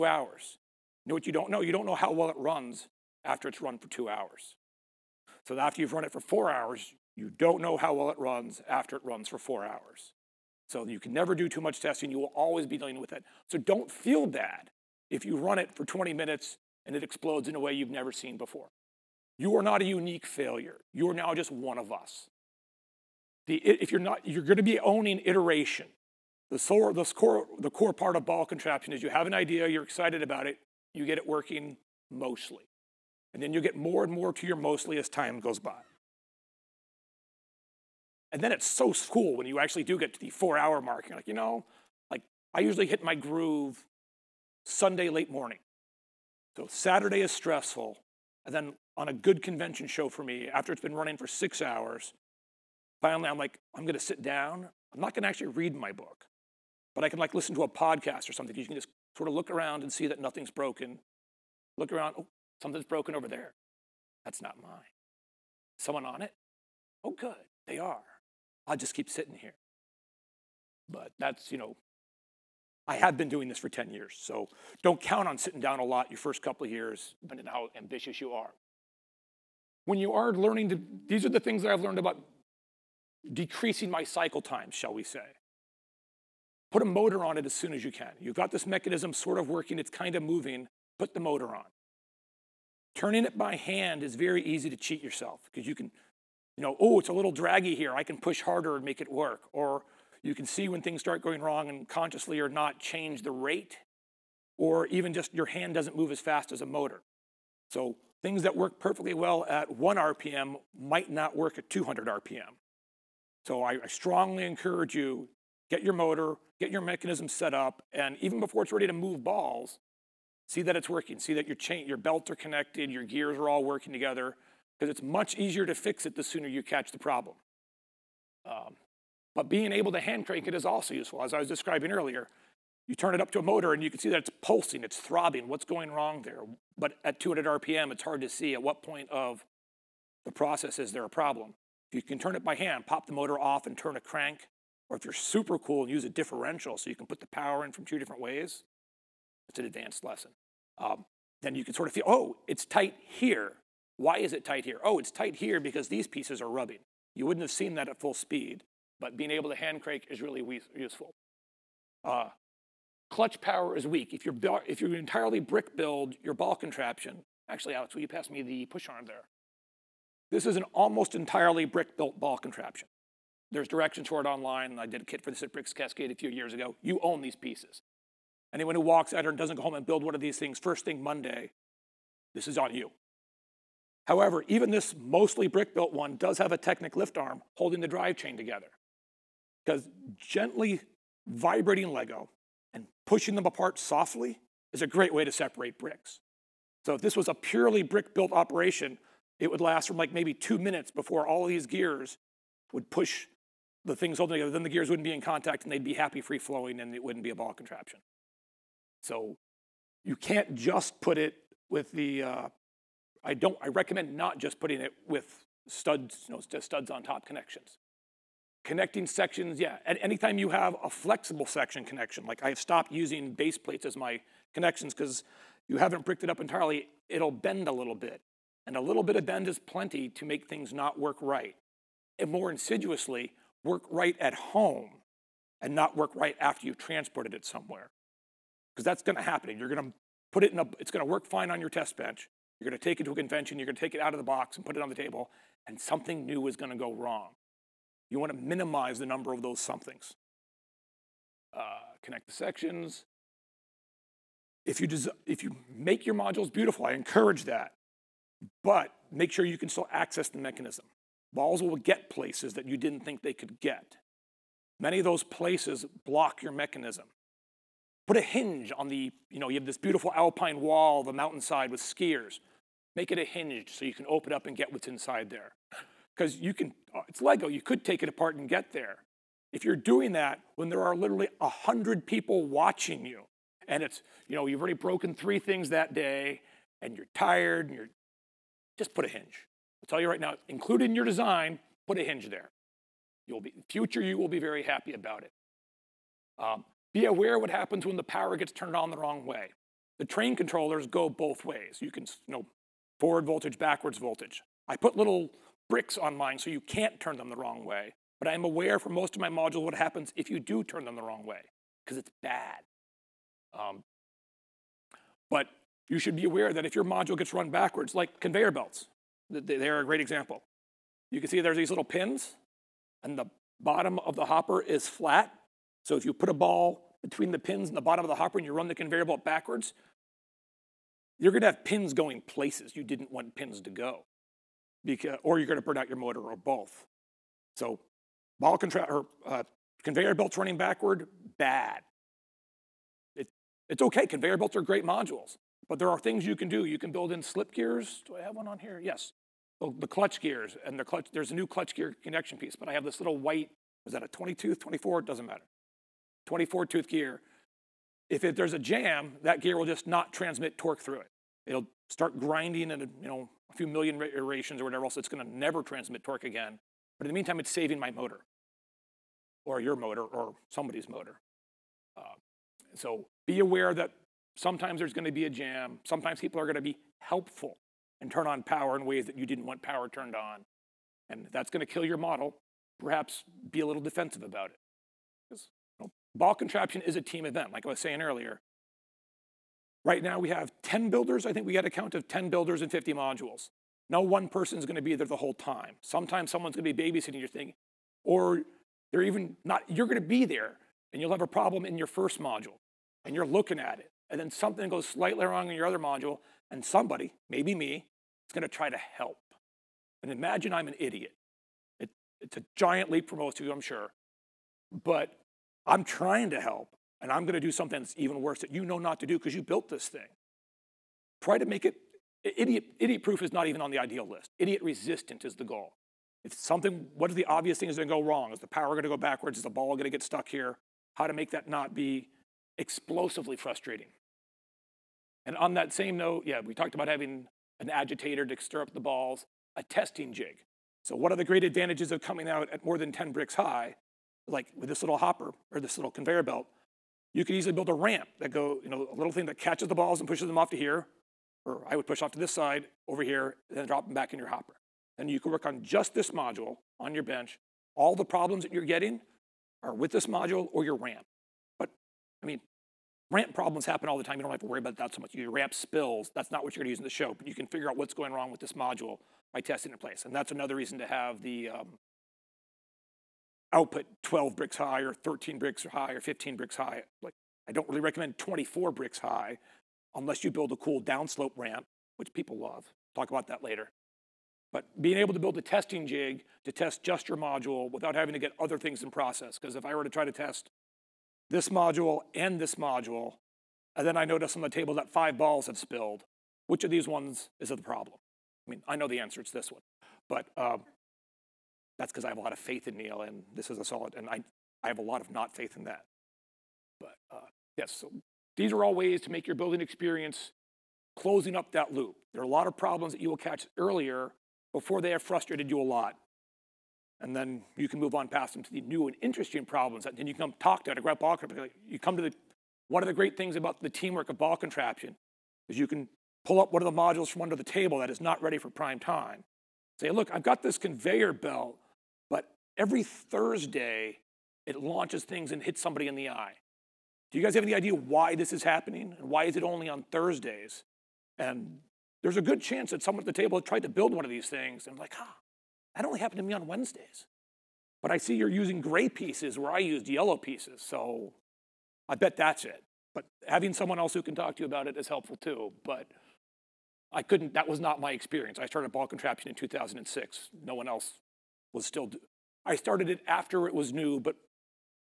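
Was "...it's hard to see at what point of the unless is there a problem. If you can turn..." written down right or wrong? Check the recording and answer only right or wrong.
wrong.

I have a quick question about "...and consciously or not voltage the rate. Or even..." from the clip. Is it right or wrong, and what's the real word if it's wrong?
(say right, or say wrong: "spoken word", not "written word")
wrong: "change", not "voltage".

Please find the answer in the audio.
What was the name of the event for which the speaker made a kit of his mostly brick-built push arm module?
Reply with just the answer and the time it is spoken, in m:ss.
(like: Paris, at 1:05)
BrickCascade, at 2:55.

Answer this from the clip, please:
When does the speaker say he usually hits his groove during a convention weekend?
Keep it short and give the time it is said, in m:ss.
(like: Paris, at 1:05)
Sunday late morning, at 0:44.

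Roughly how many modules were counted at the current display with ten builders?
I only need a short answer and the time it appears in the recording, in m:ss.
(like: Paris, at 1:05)
50, at 6:32.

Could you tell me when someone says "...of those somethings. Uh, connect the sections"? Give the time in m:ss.
4:09.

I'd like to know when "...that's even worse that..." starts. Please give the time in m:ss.
6:57.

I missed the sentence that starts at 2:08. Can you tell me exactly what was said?
Um, but being able to hand crank it is also useful.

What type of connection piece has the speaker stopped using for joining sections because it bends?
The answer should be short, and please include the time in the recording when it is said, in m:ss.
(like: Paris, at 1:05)
base plates, at 3:43.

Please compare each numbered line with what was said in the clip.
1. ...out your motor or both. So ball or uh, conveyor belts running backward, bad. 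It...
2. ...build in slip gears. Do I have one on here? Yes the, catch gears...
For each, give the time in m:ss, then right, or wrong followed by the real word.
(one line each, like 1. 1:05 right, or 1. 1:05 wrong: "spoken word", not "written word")
1. 5:35 right
2. 5:46 wrong: "clutch", not "catch".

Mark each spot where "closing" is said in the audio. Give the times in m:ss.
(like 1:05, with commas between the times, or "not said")
8:30.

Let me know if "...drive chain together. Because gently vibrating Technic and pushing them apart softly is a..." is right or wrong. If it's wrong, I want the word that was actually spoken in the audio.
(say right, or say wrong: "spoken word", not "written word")
wrong: "Lego", not "Technic".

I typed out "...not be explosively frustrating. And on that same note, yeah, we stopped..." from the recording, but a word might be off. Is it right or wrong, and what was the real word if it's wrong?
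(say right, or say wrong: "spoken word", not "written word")
wrong: "talked", not "stopped".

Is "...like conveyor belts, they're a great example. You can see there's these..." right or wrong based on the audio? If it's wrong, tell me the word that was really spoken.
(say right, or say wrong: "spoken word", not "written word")
right.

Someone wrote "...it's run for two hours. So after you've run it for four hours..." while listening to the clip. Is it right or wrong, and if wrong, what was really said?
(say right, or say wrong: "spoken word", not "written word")
right.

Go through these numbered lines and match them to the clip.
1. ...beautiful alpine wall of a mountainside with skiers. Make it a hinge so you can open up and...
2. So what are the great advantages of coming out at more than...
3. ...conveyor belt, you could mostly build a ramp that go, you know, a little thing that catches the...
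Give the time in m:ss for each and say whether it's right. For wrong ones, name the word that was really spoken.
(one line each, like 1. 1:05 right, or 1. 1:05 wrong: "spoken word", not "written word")
1. 4:29 right
2. 7:20 right
3. 7:25 wrong: "easily", not "mostly".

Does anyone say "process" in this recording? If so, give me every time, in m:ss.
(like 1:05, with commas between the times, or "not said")
2:20, 8:08.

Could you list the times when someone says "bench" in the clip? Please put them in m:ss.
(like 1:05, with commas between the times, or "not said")
4:01, 7:37.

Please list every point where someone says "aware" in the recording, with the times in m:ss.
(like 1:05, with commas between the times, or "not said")
4:57, 5:08, 5:16, 6:13.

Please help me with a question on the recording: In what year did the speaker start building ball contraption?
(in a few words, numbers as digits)
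2006.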